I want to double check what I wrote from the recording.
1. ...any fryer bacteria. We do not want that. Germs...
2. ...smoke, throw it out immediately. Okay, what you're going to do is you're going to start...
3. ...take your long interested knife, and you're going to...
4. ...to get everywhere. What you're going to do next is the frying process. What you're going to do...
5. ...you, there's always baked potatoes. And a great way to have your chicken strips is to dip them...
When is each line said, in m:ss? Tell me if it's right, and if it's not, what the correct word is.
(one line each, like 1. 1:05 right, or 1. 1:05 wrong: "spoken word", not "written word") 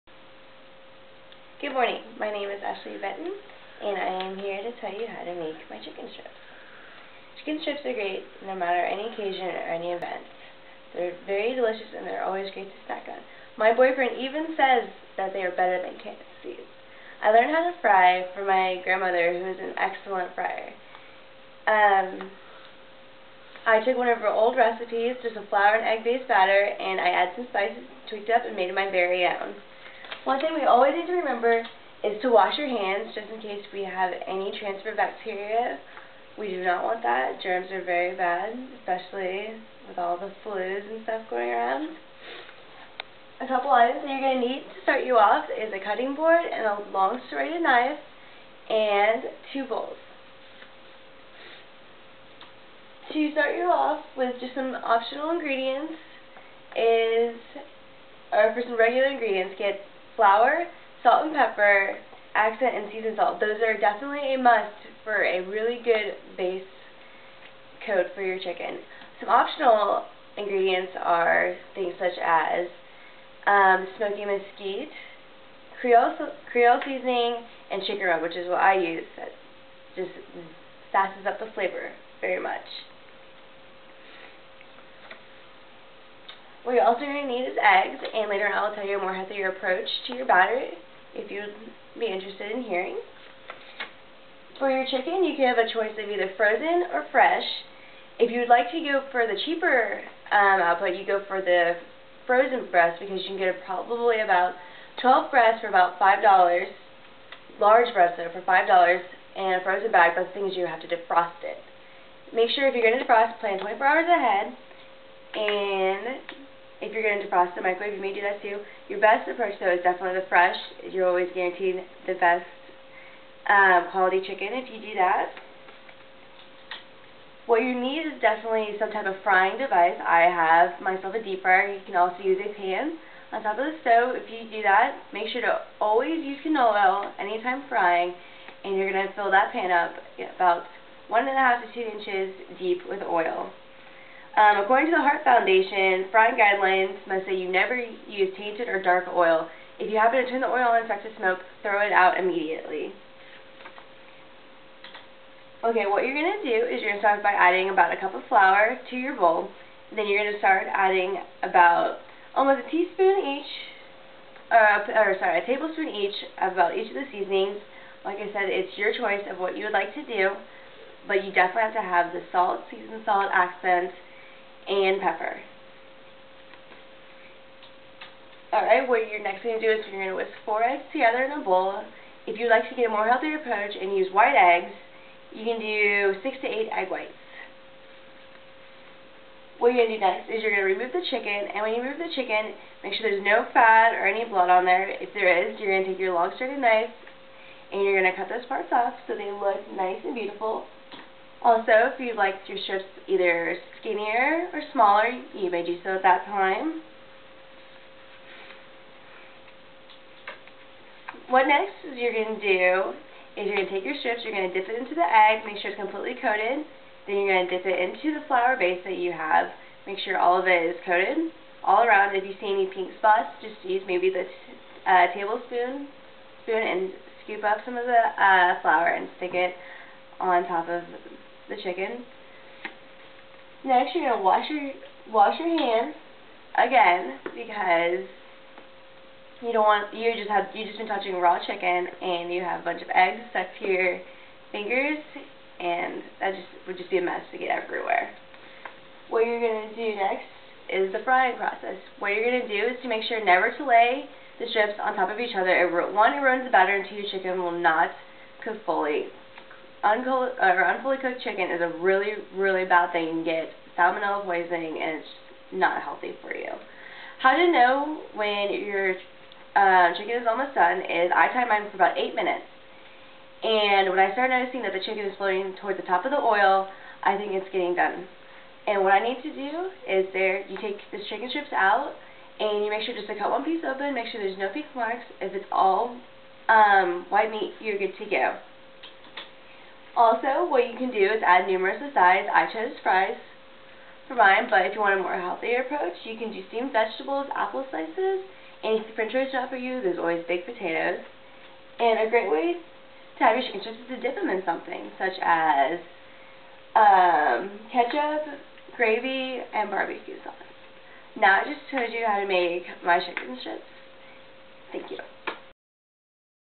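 1. 0:34 wrong: "transfer", not "fryer"
2. 2:31 right
3. 3:15 wrong: "straightened", not "interested"
4. 4:07 right
5. 4:59 right.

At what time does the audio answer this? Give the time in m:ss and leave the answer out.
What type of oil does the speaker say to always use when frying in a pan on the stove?
2:16.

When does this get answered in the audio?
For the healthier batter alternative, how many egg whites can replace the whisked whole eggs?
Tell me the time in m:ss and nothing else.
3:06.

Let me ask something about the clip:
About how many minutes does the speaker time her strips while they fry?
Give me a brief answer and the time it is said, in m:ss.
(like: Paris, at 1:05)
8 minutes, at 4:31.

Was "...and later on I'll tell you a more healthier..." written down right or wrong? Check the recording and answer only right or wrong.
right.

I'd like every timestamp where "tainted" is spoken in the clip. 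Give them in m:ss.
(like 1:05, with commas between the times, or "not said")
2:28.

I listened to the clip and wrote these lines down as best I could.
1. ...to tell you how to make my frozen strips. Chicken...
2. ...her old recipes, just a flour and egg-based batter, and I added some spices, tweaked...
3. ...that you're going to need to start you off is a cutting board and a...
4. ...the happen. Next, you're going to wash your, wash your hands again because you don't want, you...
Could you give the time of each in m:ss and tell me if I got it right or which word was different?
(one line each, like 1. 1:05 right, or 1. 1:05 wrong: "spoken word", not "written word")
1. 0:04 wrong: "chicken", not "frozen"
2. 0:24 right
3. 0:44 right
4. 3:51 wrong: "chicken", not "happen".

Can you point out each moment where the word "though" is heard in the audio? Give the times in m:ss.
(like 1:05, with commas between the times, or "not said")
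1:48, 1:59.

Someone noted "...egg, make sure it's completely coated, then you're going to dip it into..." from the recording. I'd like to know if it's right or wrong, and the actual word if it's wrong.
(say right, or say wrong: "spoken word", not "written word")
right.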